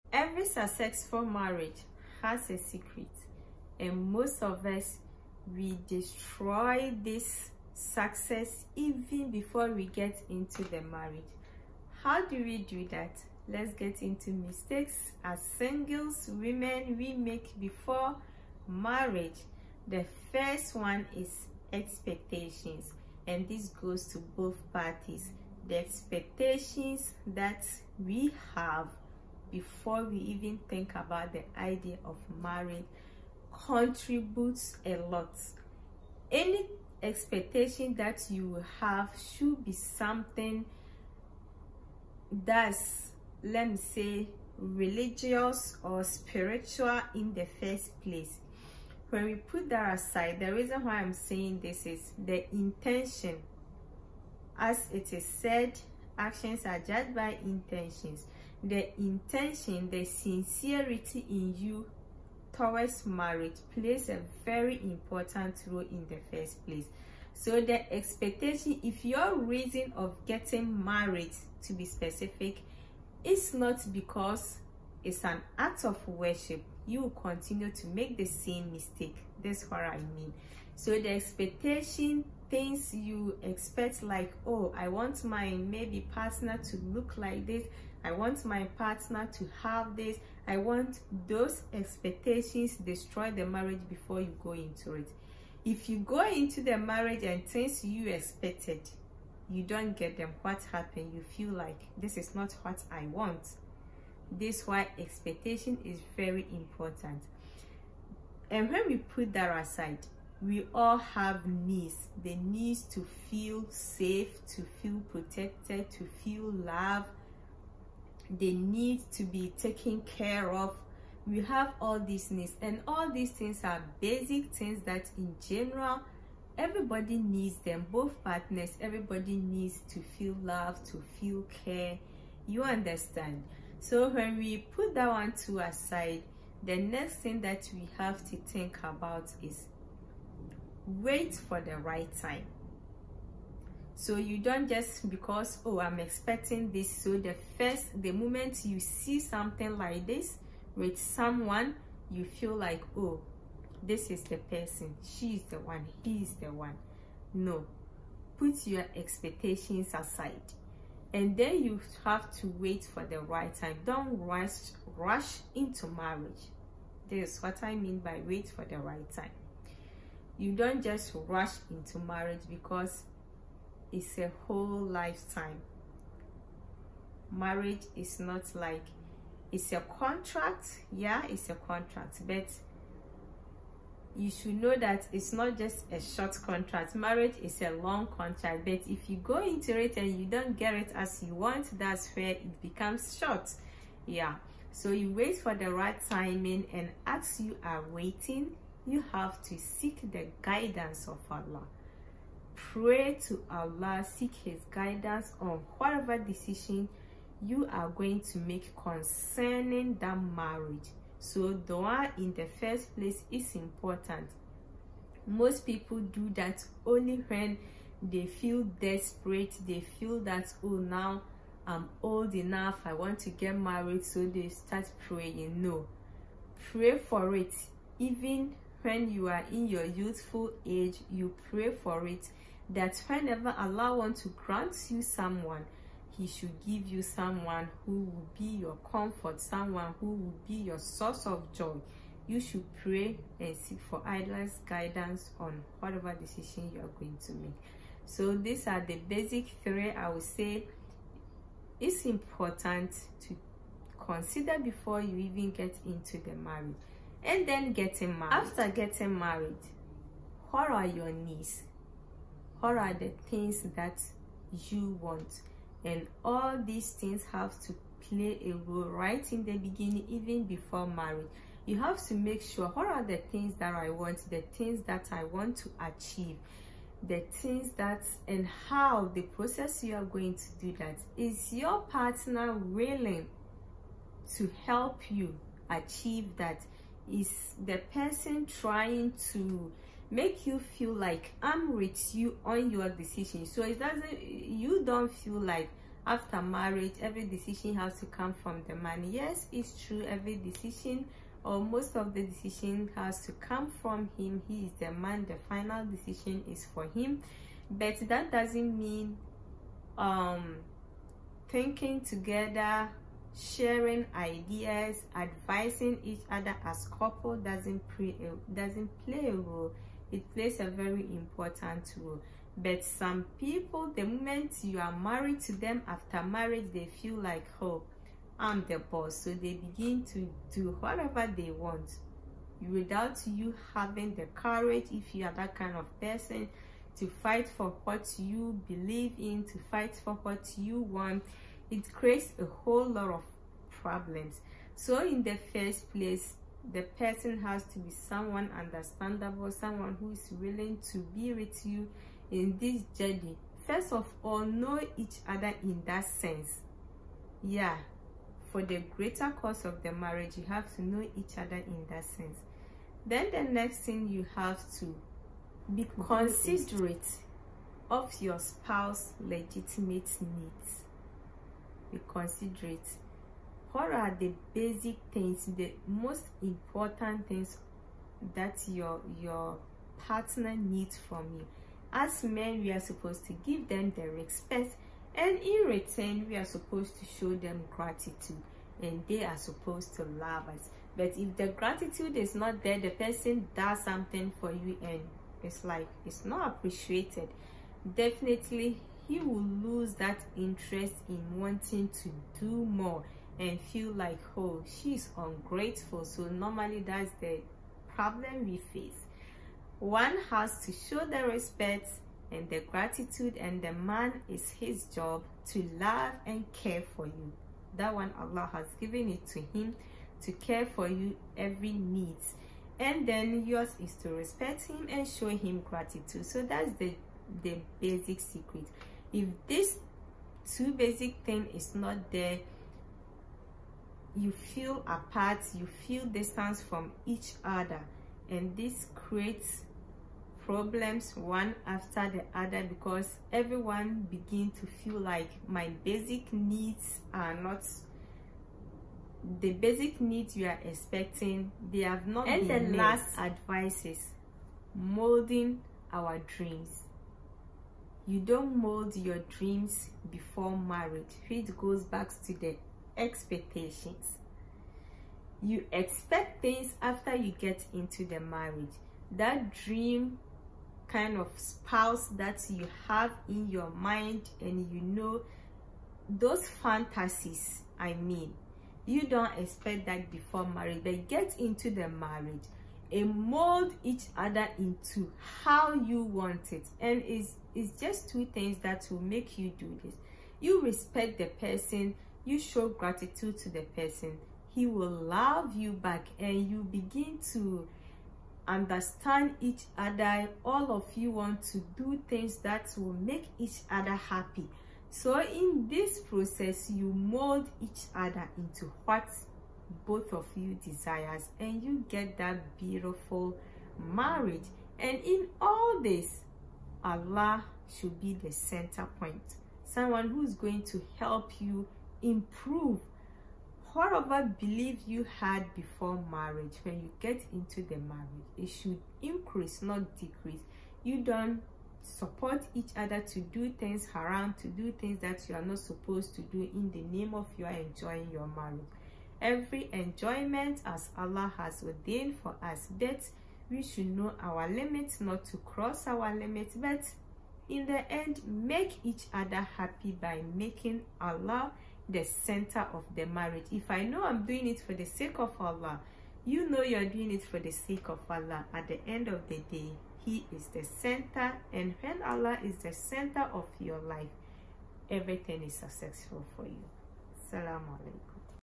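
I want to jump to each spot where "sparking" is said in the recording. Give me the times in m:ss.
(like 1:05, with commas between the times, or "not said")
not said.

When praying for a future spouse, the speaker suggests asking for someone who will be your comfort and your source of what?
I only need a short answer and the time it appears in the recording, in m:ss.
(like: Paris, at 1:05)
Joy, at 4:00.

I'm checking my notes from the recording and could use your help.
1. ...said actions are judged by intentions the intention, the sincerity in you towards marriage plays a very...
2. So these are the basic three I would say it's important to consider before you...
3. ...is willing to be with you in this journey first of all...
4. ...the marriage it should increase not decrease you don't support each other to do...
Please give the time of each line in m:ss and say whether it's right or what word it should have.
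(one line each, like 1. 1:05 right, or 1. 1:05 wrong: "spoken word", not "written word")
1. 0:55 right
2. 4:08 right
3. 5:50 right
4. 8:47 right.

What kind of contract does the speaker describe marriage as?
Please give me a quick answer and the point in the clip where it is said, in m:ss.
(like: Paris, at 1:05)
A long contract, at 3:06.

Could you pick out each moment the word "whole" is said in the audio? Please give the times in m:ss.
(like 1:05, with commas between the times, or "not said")
2:54, 5:42.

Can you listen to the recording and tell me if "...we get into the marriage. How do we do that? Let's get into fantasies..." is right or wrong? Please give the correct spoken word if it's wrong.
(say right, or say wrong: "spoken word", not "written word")
wrong: "mistakes", not "fantasies".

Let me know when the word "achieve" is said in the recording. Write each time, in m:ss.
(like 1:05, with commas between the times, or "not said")
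4:35, 4:45.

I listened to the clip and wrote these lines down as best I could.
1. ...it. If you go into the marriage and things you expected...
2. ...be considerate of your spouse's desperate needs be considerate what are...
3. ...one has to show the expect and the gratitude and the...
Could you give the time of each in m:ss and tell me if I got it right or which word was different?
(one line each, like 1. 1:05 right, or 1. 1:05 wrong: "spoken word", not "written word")
1. 1:34 right
2. 6:05 wrong: "legitimate", not "desperate"
3. 6:49 wrong: "respect", not "expect".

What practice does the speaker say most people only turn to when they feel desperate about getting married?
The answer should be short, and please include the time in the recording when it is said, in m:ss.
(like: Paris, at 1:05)
Dua, at 3:31.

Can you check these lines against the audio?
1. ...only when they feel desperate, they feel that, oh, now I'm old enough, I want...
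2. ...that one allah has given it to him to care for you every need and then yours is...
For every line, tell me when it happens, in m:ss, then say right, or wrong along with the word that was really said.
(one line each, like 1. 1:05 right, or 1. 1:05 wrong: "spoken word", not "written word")
1. 3:36 right
2. 6:57 right.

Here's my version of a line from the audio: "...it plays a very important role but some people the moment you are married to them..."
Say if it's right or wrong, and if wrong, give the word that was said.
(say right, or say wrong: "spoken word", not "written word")
right.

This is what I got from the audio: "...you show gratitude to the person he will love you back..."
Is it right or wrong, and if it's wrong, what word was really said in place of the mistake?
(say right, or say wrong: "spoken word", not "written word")
right.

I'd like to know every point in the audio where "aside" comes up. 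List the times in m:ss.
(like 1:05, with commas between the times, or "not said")
0:49, 1:49, 2:15, 2:39.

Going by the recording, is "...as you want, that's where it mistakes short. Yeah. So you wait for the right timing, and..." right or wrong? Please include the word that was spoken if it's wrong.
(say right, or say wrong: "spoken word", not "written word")
wrong: "becomes", not "mistakes".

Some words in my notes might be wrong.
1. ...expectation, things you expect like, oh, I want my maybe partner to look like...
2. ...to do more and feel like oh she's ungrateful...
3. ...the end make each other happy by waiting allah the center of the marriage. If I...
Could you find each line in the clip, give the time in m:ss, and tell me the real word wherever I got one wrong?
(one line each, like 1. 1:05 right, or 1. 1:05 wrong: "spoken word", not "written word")
1. 1:21 right
2. 6:41 right
3. 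9:07 wrong: "making", not "waiting".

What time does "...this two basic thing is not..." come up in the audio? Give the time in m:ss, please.
7:09.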